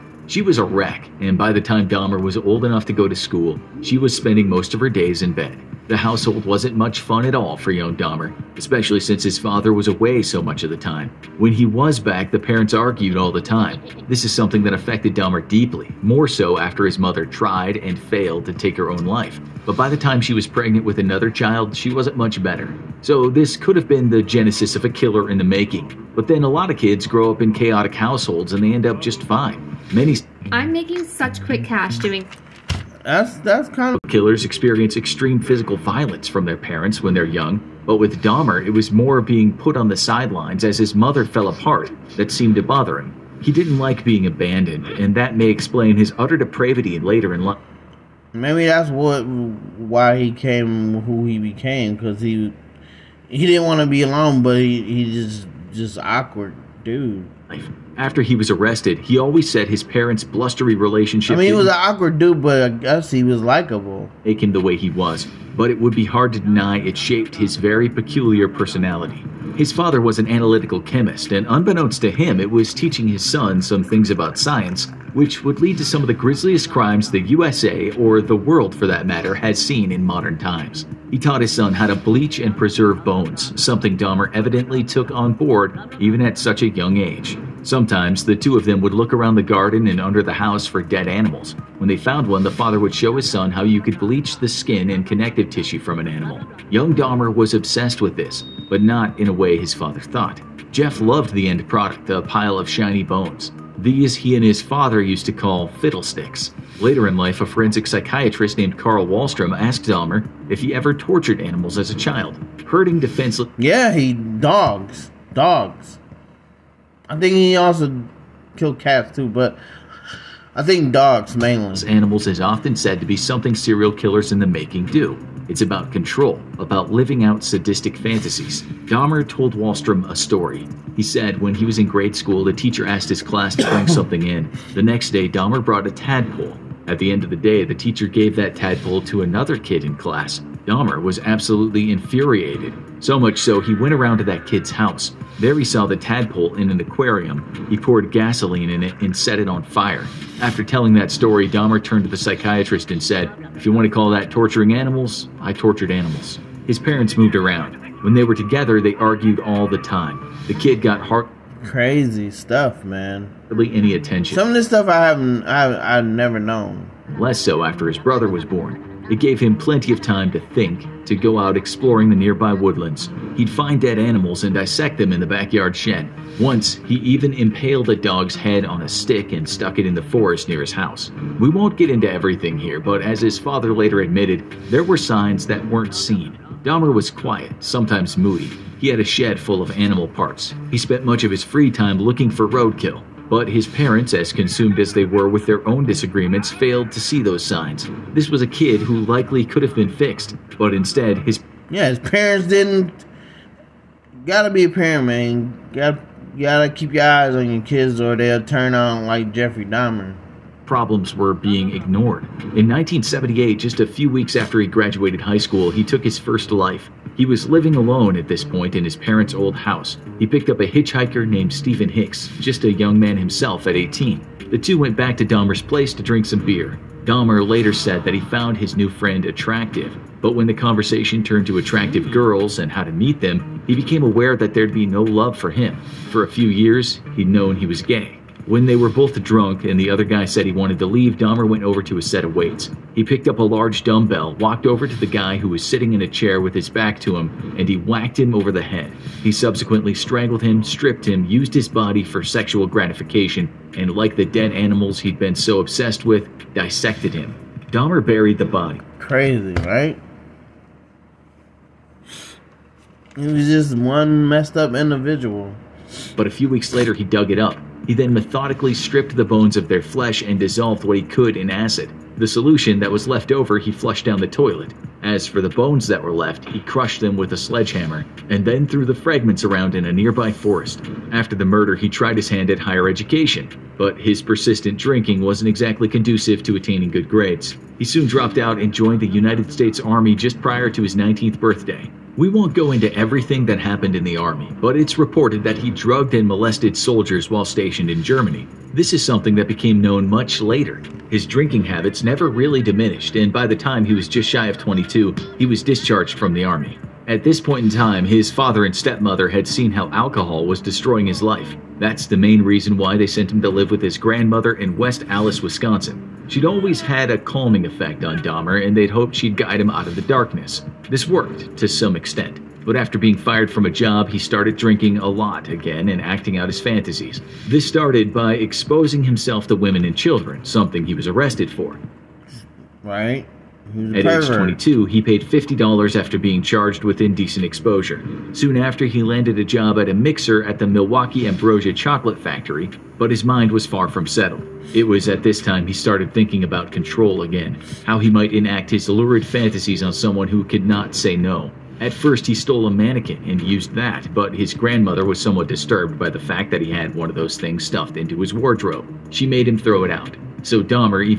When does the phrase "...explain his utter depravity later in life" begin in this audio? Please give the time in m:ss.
0:45.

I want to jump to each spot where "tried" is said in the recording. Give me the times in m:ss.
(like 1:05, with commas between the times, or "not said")
0:17, 4:41.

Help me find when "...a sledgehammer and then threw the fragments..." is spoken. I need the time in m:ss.
4:37.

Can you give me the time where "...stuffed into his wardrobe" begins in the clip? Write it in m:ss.
5:57.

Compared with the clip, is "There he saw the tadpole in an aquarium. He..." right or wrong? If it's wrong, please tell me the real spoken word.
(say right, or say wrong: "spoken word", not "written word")
right.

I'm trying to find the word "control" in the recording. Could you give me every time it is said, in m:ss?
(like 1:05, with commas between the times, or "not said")
2:05, 5:46.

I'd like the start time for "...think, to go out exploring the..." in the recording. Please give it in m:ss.
2:50.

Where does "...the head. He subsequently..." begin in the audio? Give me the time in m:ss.
4:08.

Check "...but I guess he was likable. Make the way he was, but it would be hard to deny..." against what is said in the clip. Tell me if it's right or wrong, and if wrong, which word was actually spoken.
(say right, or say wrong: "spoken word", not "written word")
right.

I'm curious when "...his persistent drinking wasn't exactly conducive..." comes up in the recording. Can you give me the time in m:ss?
4:43.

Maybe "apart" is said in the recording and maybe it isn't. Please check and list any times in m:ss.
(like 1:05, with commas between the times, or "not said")
0:41.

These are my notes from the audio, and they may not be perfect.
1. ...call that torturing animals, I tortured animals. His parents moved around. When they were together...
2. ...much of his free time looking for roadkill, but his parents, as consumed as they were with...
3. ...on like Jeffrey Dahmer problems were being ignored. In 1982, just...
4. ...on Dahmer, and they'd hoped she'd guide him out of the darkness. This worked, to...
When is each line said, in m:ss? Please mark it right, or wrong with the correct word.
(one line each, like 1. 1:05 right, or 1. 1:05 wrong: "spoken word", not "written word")
1. 2:33 right
2. 3:11 right
3. 3:28 wrong: "1978", not "1982"
4. 5:18 right.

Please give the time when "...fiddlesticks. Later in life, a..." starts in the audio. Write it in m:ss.
1:45.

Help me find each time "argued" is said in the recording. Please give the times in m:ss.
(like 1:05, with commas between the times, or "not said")
0:12, 2:38.